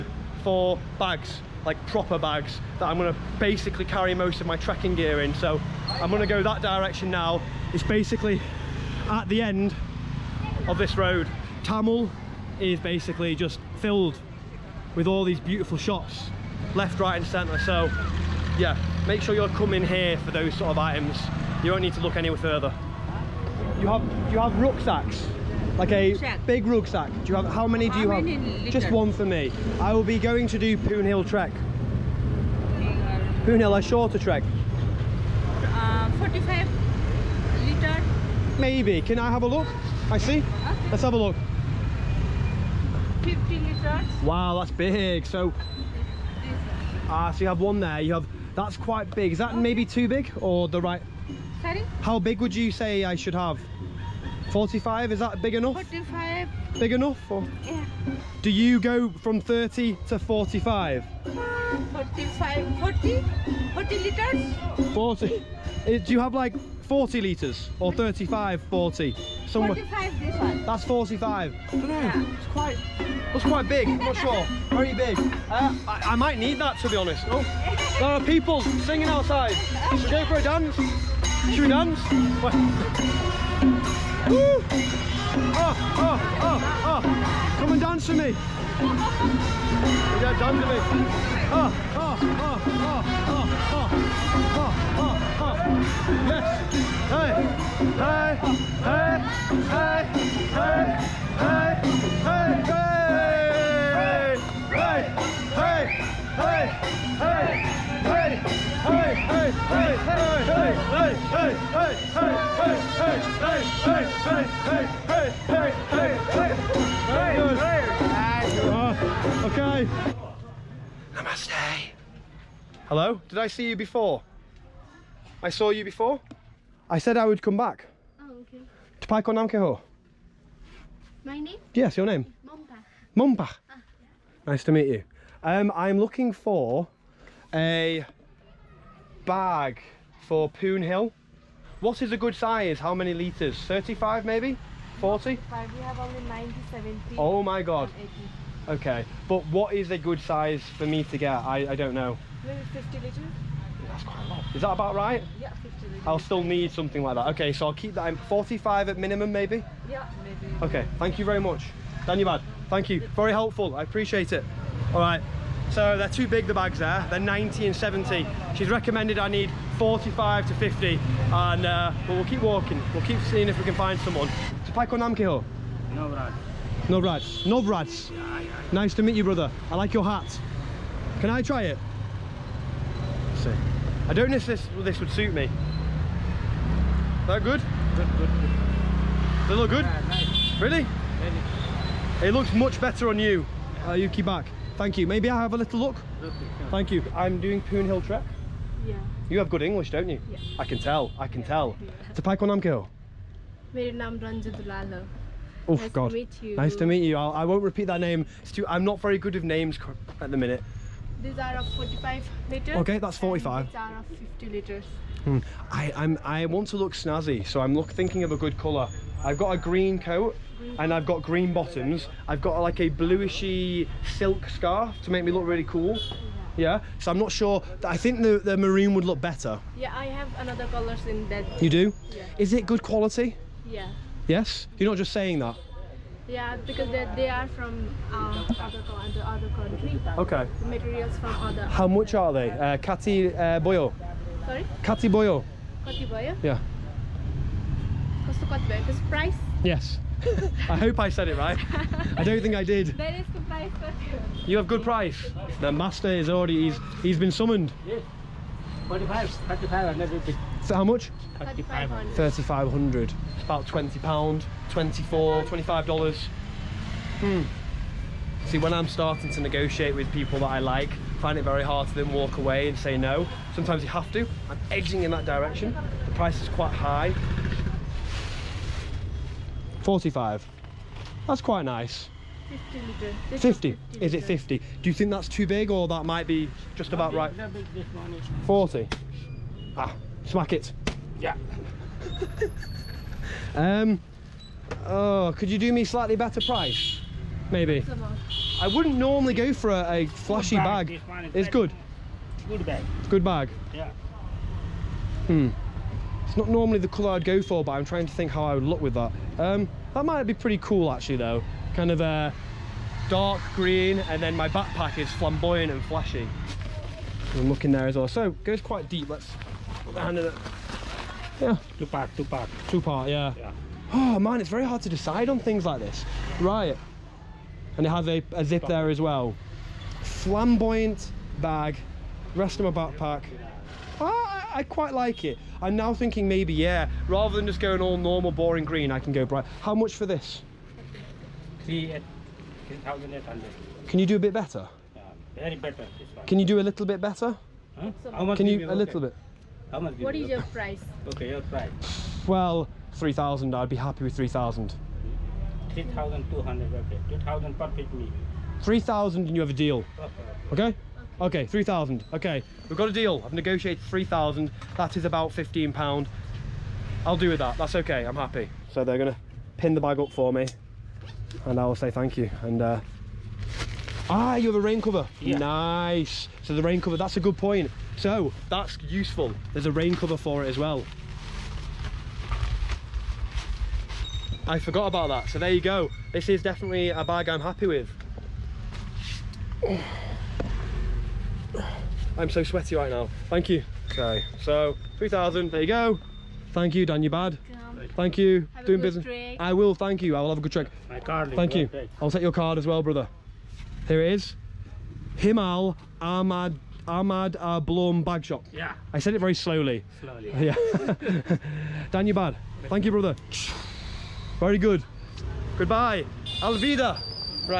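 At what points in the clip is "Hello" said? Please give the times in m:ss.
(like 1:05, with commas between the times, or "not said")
2:02.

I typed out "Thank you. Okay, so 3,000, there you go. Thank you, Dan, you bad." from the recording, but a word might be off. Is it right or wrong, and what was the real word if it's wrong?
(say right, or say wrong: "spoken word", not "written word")
right.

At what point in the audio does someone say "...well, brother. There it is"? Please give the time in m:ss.
6:42.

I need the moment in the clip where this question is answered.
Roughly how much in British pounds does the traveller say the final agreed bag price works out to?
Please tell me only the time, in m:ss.
6:05.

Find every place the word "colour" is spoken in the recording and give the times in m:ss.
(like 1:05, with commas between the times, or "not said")
3:38, 3:50, 5:06.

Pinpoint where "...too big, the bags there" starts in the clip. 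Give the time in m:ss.
2:46.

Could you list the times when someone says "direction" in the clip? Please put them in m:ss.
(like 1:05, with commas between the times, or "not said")
0:06, 4:35.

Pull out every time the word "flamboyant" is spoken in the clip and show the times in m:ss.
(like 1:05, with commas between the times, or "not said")
5:15, 5:30.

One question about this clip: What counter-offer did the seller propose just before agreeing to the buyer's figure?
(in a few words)
3200.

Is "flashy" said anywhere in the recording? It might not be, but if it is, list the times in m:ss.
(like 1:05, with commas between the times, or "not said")
5:00, 5:15.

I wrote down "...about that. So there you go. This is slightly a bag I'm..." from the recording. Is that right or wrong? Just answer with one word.
wrong.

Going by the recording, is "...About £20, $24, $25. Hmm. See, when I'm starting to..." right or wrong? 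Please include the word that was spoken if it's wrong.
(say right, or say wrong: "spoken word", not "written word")
right.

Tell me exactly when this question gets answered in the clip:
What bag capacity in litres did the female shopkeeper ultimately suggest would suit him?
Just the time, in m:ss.
2:32.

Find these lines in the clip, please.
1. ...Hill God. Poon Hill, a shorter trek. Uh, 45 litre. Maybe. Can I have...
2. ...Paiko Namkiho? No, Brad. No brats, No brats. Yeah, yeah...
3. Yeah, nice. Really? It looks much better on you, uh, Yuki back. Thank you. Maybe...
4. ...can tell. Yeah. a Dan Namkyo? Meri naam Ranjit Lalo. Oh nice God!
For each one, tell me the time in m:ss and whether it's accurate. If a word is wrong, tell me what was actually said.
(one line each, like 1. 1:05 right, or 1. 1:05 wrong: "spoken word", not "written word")
1. 0:31 wrong: "Trek", not "God"
2. 2:54 right
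3. 3:09 right
4. 3:21 wrong: "Paiko", not "Dan".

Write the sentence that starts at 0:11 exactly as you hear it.
Thamel is basically just filled with all these beautiful shops left, right and centre.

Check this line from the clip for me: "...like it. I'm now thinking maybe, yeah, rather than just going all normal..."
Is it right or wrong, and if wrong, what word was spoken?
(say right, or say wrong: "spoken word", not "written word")
right.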